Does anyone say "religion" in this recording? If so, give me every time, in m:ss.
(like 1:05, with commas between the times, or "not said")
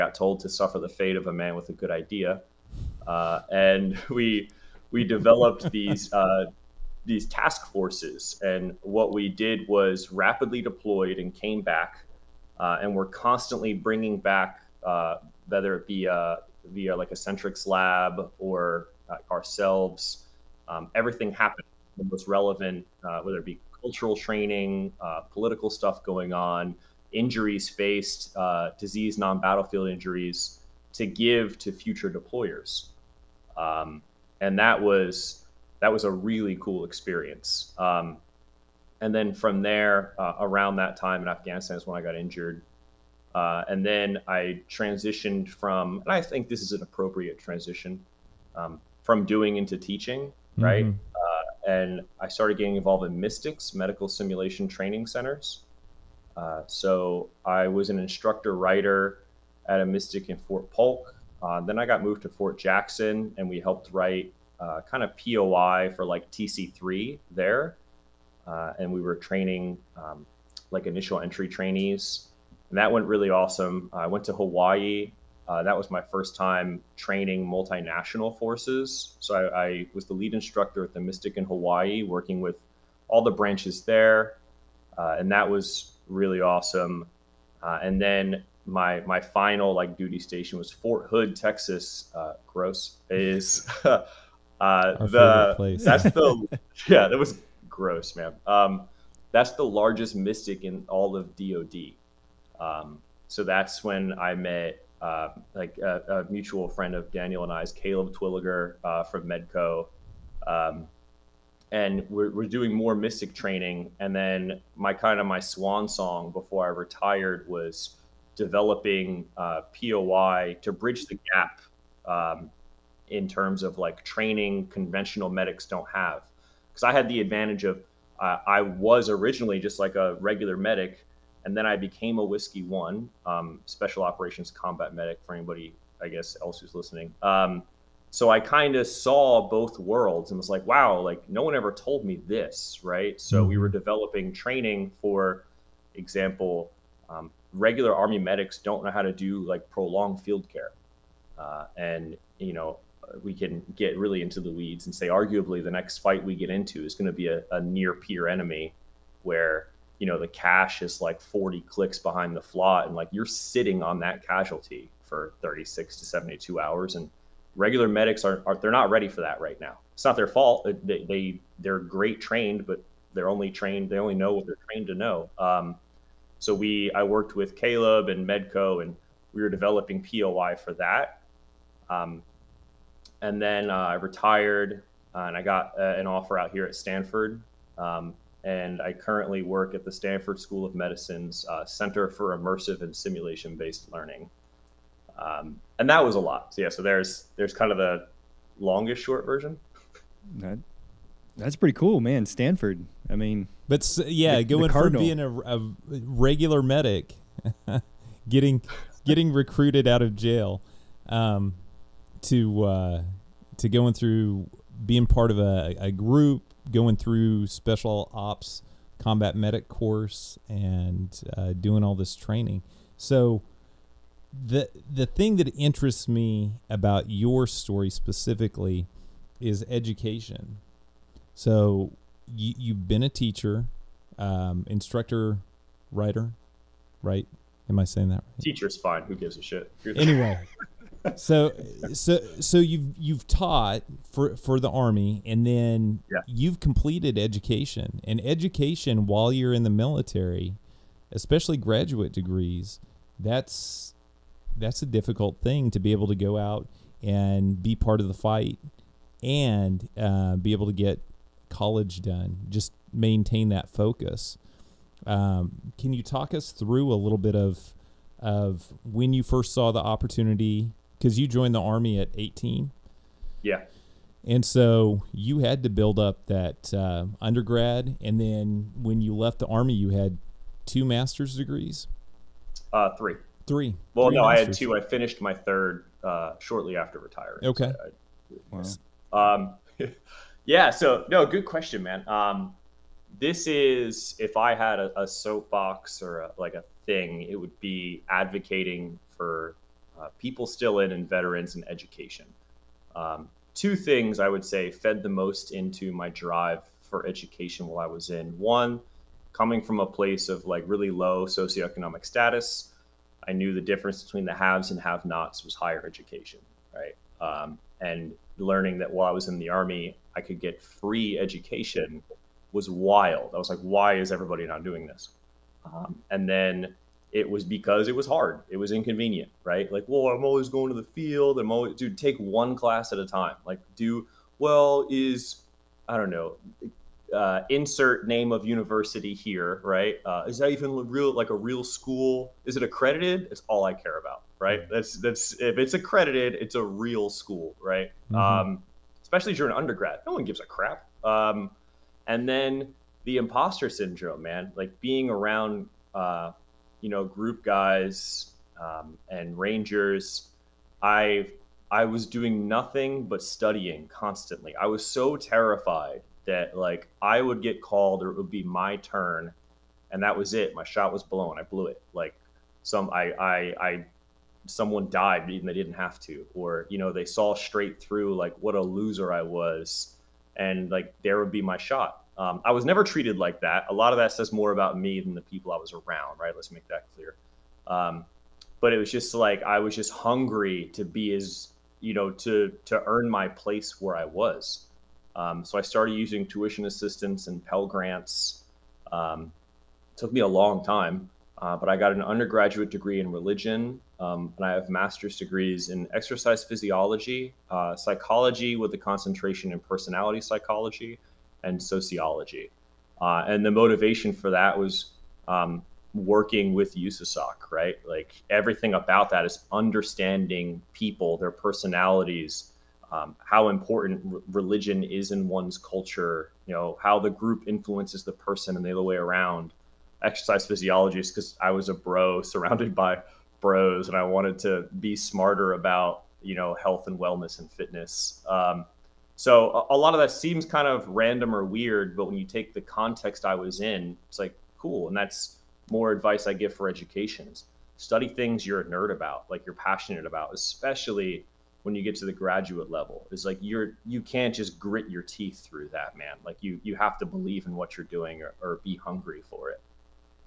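6:43, 7:04.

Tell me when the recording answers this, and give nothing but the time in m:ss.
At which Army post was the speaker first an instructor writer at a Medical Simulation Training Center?
1:00.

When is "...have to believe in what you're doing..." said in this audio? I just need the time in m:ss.
7:36.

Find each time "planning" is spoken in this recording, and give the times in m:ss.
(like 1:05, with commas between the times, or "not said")
not said.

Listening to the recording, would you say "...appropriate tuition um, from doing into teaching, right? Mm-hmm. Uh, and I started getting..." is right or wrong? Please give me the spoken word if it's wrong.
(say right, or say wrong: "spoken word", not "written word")
wrong: "transition", not "tuition".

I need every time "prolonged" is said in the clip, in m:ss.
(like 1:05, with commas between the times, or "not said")
2:29.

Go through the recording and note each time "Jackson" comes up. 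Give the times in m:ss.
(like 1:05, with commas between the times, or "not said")
1:02.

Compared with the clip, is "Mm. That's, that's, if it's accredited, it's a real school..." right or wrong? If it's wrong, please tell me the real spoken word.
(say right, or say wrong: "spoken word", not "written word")
right.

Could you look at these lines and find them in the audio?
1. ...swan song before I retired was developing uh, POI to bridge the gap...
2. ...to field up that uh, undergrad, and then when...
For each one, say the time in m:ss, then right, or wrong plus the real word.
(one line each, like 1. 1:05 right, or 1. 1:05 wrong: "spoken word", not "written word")
1. 1:55 right
2. 4:35 wrong: "build", not "field".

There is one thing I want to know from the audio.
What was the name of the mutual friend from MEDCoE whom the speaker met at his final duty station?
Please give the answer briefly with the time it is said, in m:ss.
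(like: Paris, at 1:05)
Caleb Twilliger, at 1:47.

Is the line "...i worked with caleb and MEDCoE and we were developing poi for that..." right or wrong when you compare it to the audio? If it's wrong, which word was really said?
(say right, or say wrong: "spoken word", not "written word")
right.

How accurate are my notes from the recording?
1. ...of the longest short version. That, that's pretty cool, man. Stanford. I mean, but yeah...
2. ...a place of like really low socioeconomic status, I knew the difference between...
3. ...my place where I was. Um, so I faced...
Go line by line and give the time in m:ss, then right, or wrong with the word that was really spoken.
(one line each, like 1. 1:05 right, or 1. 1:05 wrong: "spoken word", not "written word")
1. 3:17 right
2. 5:09 right
3. 6:33 wrong: "started", not "faced".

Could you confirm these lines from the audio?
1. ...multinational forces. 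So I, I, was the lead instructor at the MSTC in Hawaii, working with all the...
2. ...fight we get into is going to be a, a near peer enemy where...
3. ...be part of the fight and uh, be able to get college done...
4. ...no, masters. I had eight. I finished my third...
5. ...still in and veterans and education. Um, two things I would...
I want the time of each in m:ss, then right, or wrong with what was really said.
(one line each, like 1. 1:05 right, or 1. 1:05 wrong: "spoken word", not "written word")
1. 1:17 right
2. 2:35 right
3. 4:17 right
4. 4:44 wrong: "two", not "eight"
5. 5:00 right.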